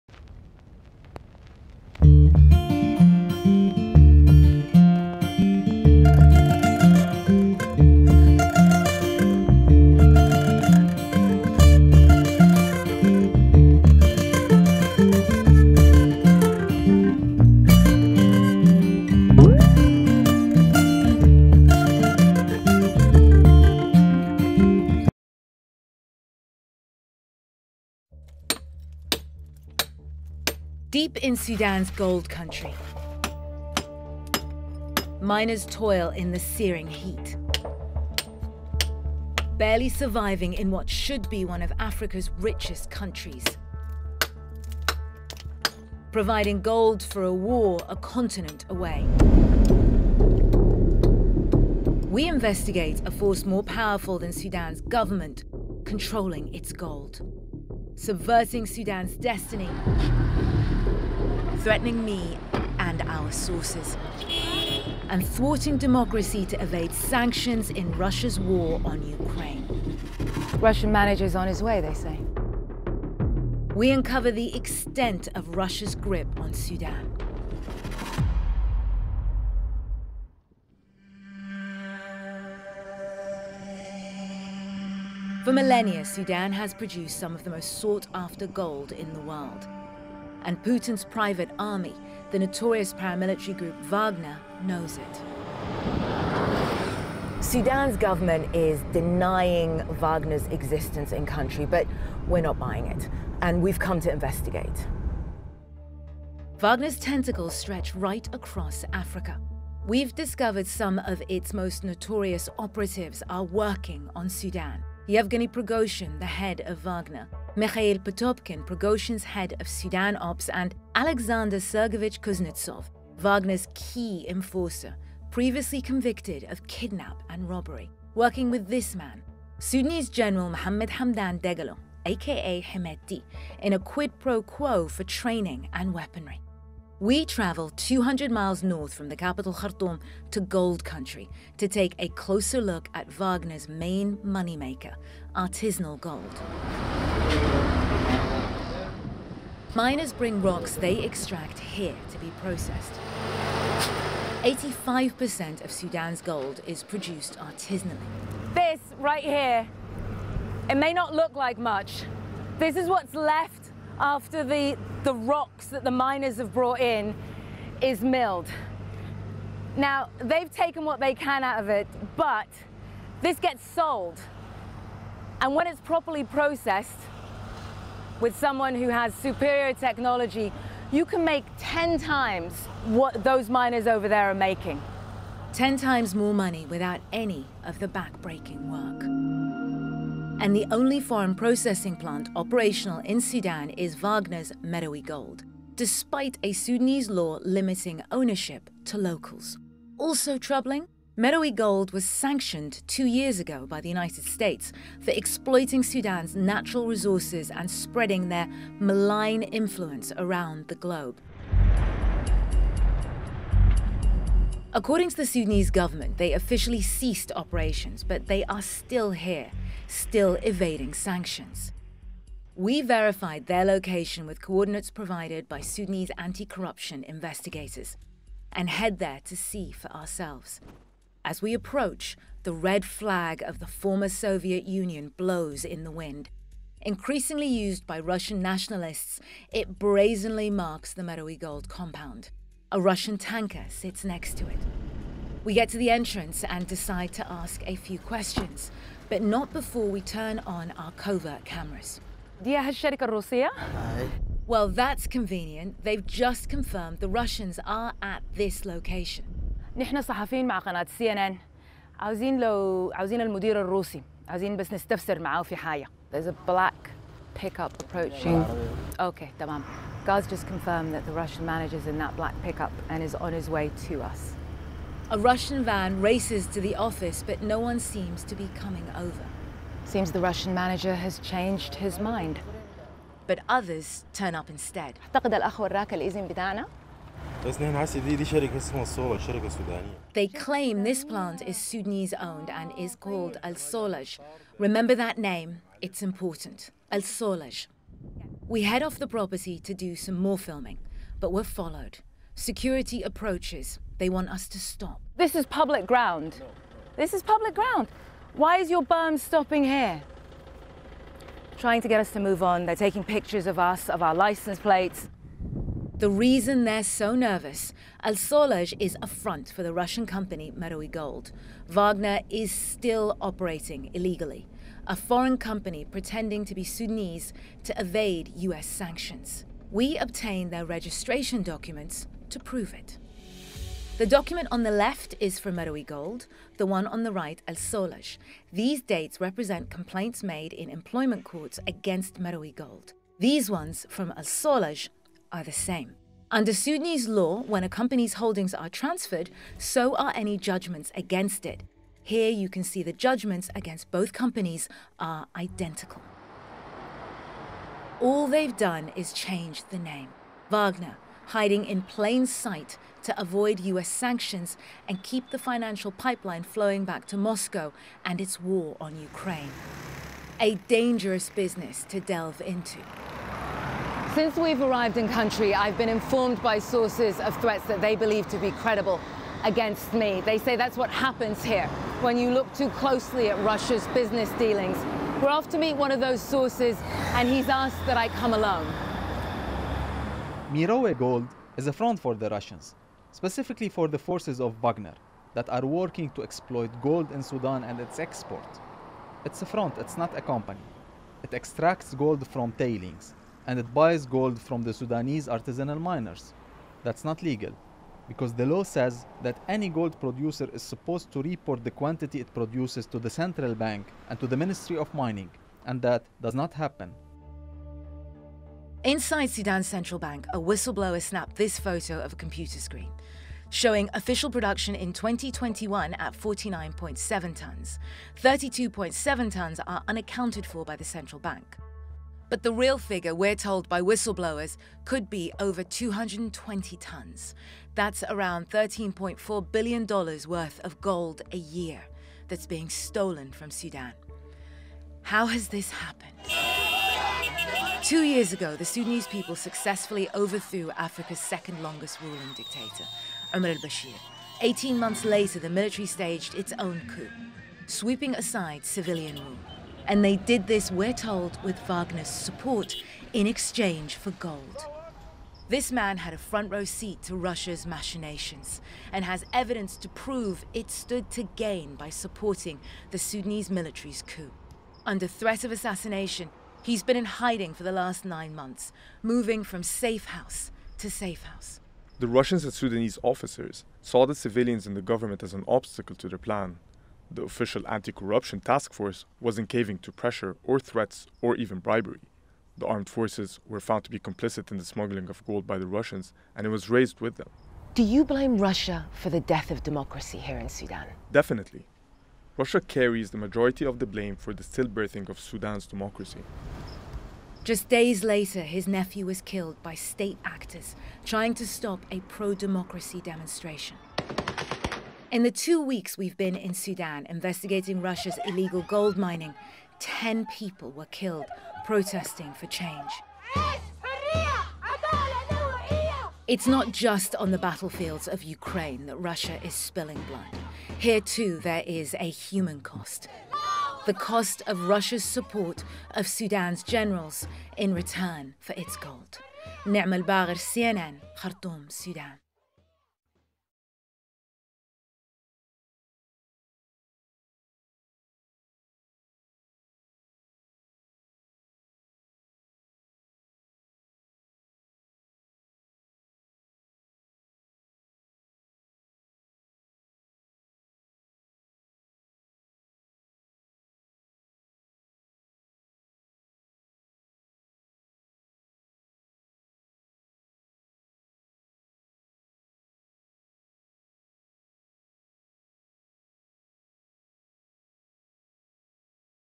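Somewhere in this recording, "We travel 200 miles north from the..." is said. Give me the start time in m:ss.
2:17.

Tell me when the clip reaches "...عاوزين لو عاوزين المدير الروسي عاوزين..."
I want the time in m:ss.
4:21.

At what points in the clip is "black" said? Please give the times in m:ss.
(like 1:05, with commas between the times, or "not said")
4:26, 4:32.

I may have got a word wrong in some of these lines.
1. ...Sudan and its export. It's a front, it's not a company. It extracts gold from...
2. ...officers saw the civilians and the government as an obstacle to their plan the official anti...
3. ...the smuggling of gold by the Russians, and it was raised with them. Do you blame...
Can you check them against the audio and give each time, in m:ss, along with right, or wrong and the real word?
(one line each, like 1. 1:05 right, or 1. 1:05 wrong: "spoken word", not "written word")
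1. 6:37 right
2. 8:03 right
3. 8:14 right.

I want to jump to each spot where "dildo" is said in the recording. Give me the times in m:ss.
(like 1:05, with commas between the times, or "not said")
not said.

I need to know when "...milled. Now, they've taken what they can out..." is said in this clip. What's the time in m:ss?
2:48.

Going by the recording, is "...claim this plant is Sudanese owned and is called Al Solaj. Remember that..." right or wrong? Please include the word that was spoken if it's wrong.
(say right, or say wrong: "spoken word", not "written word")
right.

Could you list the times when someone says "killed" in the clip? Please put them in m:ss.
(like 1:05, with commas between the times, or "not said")
8:29, 8:40.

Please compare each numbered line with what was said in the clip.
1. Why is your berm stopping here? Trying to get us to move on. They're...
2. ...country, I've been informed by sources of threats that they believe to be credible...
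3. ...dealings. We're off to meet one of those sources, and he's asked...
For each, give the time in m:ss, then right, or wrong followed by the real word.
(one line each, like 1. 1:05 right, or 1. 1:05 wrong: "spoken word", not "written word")
1. 5:08 right
2. 6:15 right
3. 6:24 right.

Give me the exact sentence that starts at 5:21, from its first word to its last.
Wagner is still operating illegally, a foreign company pretending to be Sudanese to evade US sanctions.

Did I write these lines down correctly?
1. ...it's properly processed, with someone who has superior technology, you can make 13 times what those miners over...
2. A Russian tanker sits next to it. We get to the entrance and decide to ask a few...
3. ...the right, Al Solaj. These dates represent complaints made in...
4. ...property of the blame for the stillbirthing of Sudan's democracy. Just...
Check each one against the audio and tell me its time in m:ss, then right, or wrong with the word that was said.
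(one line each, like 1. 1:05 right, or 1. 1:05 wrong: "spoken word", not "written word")
1. 2:55 wrong: "10", not "13"
2. 4:02 right
3. 5:37 right
4. 8:23 wrong: "majority", not "property".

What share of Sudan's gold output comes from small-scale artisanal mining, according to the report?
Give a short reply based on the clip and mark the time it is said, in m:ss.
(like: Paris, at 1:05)
85%, at 2:34.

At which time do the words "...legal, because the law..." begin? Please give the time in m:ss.
6:47.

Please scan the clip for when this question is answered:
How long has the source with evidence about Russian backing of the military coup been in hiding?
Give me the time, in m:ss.
7:58.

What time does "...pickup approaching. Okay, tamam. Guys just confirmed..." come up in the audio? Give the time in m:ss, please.
4:27.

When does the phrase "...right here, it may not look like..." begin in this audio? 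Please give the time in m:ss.
2:38.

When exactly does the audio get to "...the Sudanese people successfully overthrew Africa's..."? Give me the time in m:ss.
7:28.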